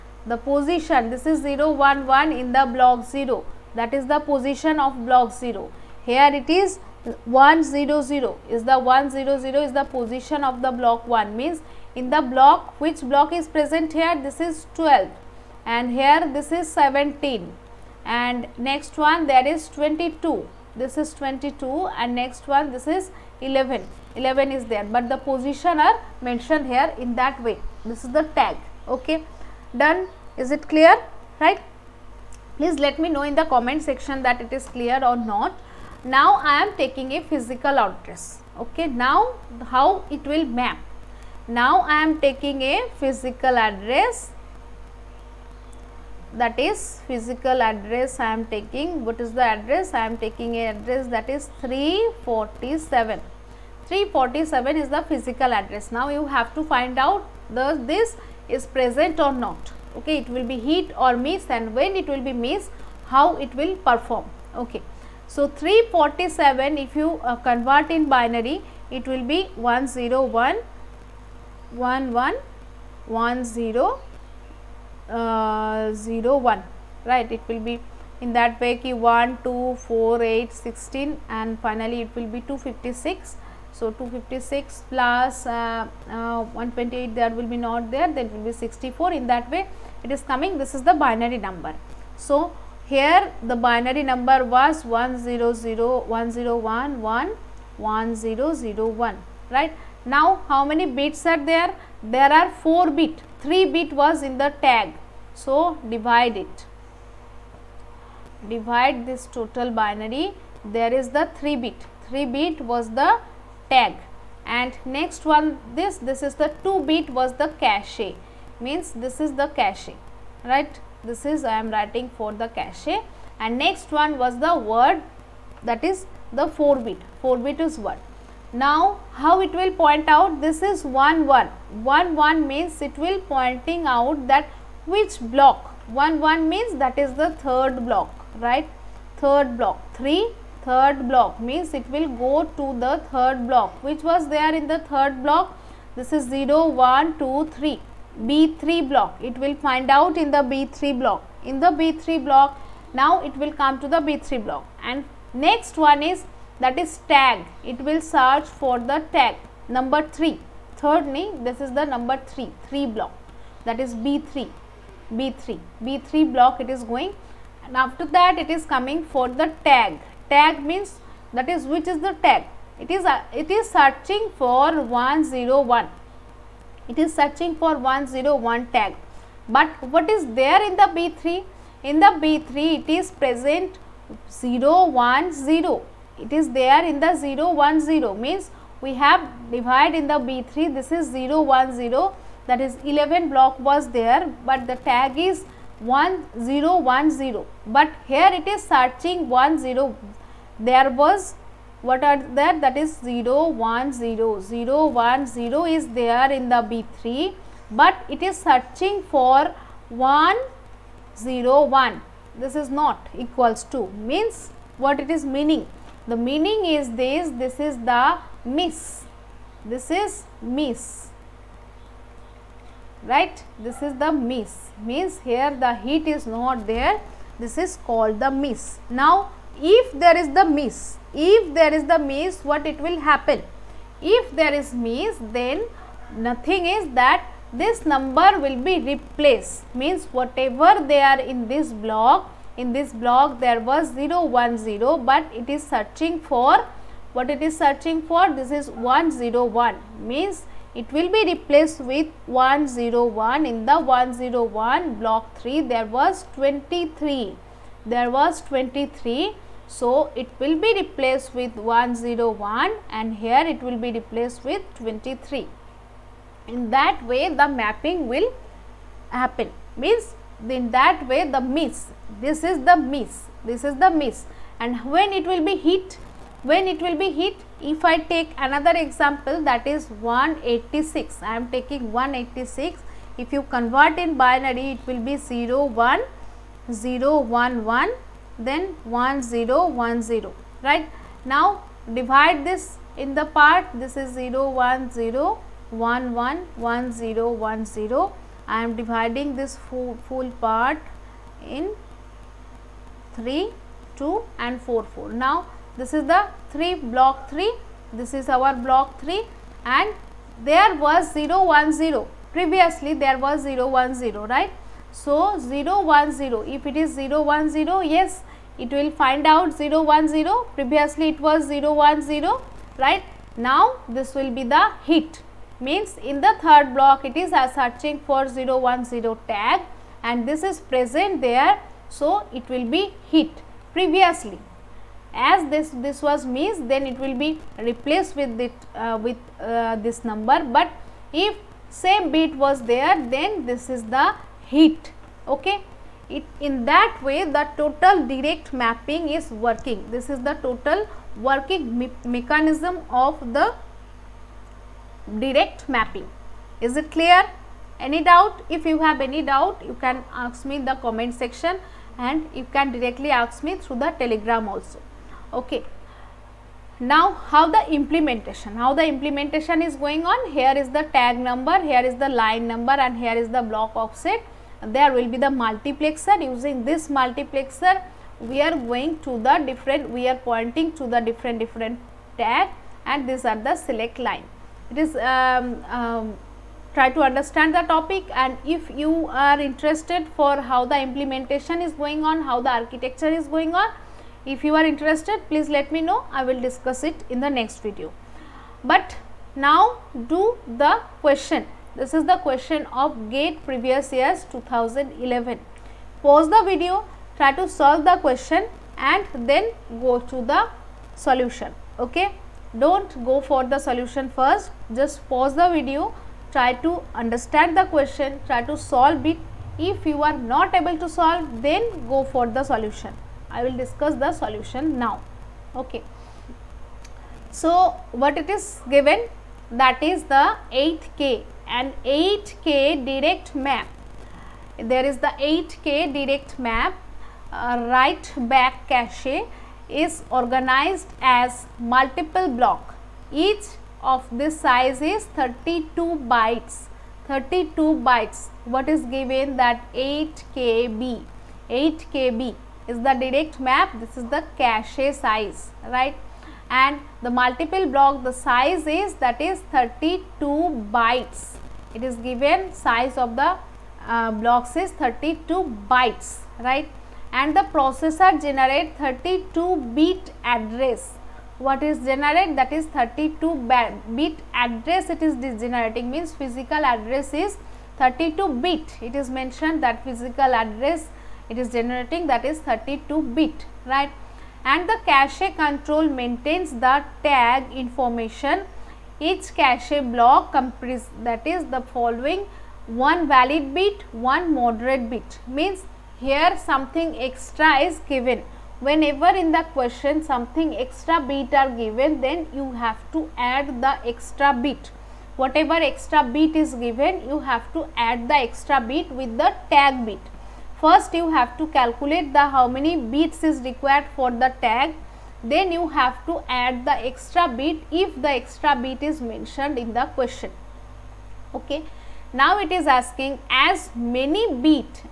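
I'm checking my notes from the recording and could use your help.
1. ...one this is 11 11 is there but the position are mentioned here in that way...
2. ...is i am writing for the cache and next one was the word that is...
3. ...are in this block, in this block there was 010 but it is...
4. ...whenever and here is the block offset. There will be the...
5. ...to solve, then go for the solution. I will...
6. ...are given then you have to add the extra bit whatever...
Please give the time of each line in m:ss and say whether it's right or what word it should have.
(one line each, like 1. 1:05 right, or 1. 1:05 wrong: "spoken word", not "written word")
1. 0:22 right
2. 2:01 right
3. 4:01 right
4. 6:12 wrong: "number", not "whenever"
5. 7:00 right
6. 8:21 right.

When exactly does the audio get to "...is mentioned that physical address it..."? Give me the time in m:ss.
7:59.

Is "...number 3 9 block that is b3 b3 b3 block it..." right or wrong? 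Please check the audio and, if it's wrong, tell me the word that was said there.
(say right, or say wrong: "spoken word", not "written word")
wrong: "3", not "9".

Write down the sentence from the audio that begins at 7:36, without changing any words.
And the multiple block, the size is that is 32 bytes.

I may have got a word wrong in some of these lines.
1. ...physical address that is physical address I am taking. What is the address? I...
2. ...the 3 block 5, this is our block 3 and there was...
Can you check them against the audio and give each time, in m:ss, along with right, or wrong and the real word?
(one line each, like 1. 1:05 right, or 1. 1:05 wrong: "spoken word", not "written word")
1. 0:42 right
2. 5:06 wrong: "3", not "5".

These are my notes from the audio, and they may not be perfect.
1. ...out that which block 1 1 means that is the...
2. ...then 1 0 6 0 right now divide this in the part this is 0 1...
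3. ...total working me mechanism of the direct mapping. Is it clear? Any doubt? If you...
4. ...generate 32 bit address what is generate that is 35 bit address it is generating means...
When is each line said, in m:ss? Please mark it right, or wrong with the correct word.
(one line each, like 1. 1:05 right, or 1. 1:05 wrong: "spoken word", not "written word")
1. 2:13 right
2. 4:48 wrong: "1", not "6"
3. 5:50 right
4. 7:48 wrong: "32", not "35".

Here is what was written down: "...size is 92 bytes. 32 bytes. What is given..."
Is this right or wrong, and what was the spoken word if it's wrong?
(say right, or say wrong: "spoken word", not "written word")
wrong: "32", not "92".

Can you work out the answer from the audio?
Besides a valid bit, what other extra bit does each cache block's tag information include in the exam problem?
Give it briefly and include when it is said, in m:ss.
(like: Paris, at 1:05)
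modified bit, at 8:14.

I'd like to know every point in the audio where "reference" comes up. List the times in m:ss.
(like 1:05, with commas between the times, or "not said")
not said.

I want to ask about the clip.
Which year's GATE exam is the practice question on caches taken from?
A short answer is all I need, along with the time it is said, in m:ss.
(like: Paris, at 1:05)
2011, at 6:44.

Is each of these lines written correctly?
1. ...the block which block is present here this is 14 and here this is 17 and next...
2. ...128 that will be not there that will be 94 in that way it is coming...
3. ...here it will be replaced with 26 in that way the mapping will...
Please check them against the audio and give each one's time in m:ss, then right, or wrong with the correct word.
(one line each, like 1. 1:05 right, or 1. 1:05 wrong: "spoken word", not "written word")
1. 0:12 wrong: "12", not "14"
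2. 1:26 wrong: "64", not "94"
3. 4:23 wrong: "23", not "26".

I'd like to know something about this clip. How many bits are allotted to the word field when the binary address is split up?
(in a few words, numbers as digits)
4.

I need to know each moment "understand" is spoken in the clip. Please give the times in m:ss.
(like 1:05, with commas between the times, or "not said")
6:27, 6:56.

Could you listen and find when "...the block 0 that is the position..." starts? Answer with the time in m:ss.
0:02.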